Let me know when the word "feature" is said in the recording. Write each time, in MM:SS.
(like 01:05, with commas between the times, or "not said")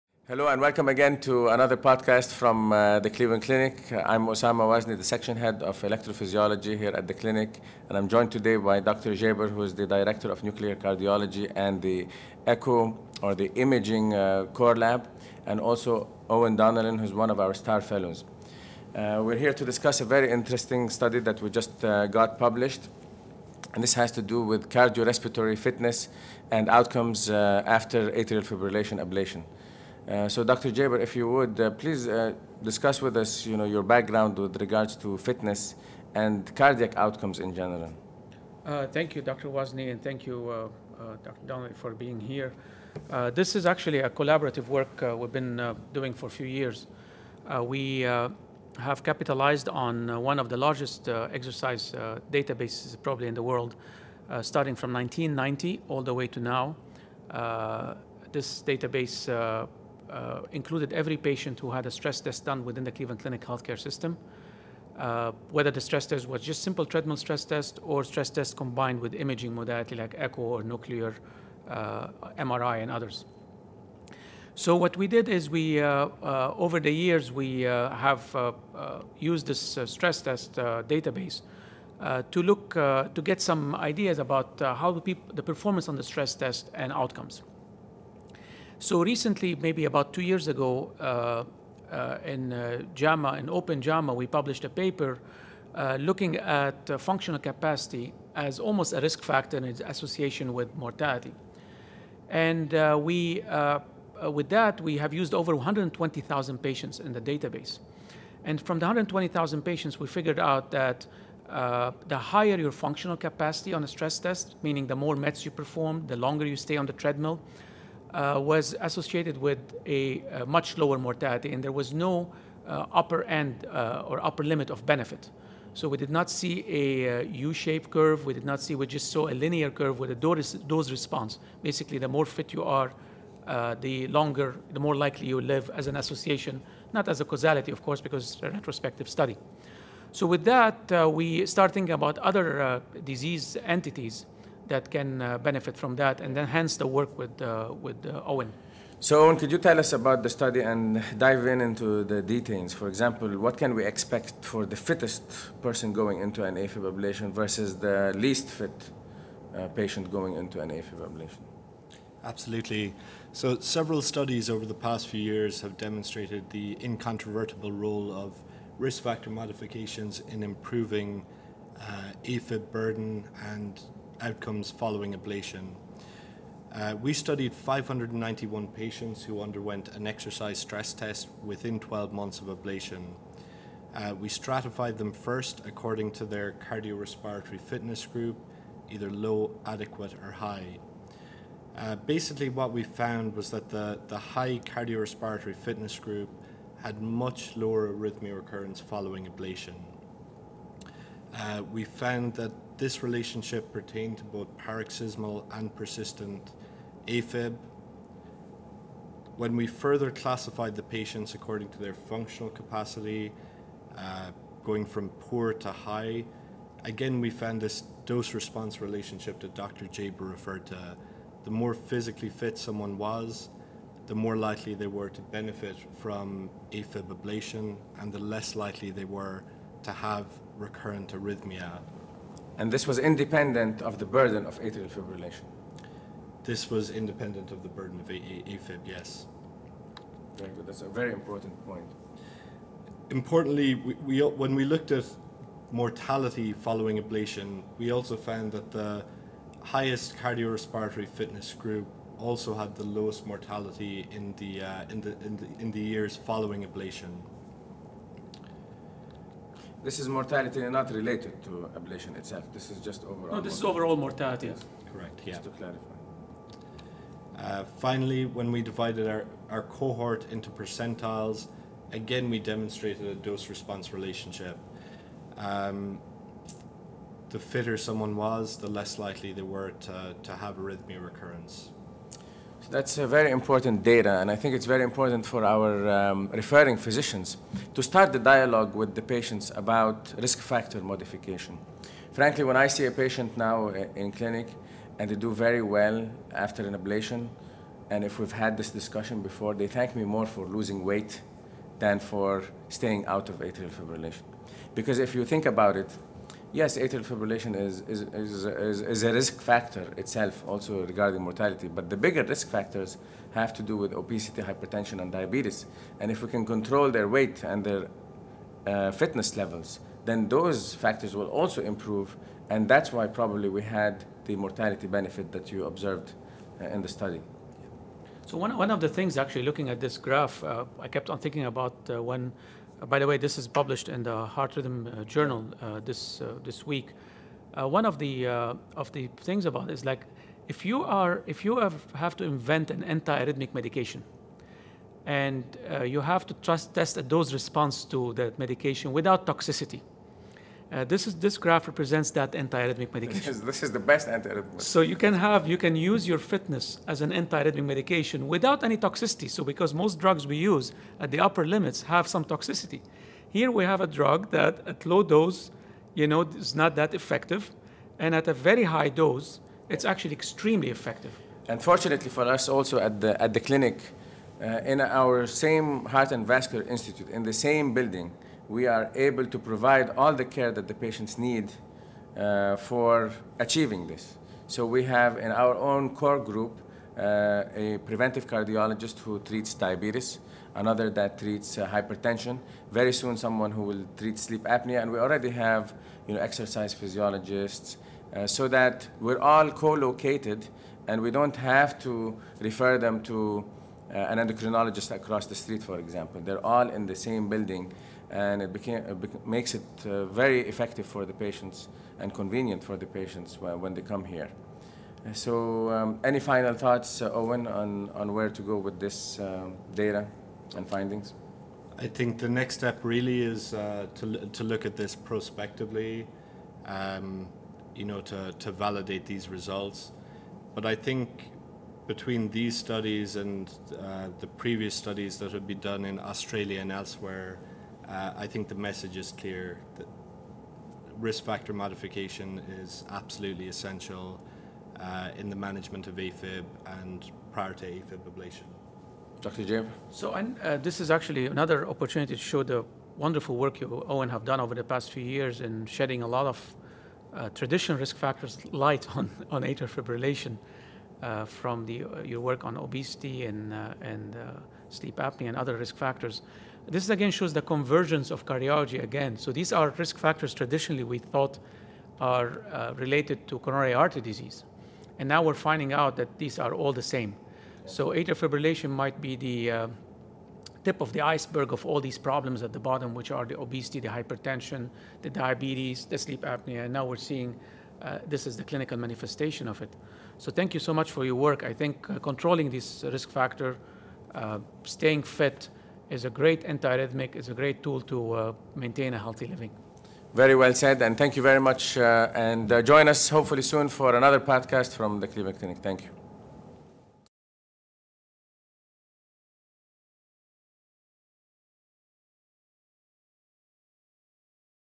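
not said.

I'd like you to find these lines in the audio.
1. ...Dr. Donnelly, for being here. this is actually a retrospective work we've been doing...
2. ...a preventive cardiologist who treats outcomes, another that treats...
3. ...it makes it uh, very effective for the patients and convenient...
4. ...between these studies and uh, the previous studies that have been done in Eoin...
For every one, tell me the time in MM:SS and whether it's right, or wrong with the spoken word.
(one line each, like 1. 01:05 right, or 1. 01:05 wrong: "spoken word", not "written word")
1. 00:41 wrong: "collaborative", not "retrospective"
2. 06:27 wrong: "diabetes", not "outcomes"
3. 06:48 right
4. 07:11 wrong: "Australia", not "Eoin".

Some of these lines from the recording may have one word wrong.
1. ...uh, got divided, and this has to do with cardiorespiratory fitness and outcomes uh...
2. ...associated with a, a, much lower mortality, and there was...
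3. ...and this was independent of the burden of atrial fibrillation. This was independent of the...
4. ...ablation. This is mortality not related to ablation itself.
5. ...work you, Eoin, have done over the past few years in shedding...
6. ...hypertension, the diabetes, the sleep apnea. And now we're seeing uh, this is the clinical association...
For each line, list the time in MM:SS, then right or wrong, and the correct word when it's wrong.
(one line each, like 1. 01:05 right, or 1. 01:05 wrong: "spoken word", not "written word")
1. 00:21 wrong: "published", not "divided"
2. 01:58 right
3. 03:52 right
4. 04:16 right
5. 07:33 right
6. 08:03 wrong: "manifestation", not "association".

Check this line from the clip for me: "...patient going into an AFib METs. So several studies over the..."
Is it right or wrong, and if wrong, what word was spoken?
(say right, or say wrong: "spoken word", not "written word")
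wrong: "Absolutely", not "METs".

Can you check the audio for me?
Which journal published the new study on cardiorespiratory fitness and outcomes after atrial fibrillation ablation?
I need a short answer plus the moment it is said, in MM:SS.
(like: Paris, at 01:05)
Heart Rhythm, at 05:34.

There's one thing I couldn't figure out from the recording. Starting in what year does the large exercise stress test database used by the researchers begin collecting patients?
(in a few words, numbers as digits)
1990.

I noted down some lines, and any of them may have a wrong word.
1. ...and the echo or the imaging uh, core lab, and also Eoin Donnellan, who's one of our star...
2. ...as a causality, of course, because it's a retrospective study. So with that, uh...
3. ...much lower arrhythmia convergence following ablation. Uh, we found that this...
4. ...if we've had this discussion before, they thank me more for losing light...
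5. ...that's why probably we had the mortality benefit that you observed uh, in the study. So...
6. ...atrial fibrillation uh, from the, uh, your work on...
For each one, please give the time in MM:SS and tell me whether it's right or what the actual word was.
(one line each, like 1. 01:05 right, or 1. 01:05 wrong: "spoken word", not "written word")
1. 00:11 right
2. 02:17 right
3. 03:17 wrong: "recurrence", not "convergence"
4. 04:58 wrong: "weight", not "light"
5. 05:22 right
6. 07:39 right.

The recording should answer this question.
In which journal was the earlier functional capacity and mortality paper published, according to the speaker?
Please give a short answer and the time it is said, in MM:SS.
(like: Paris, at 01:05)
Open JAMA, at 01:33.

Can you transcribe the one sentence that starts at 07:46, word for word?
This again shows the convergence of cardiology again.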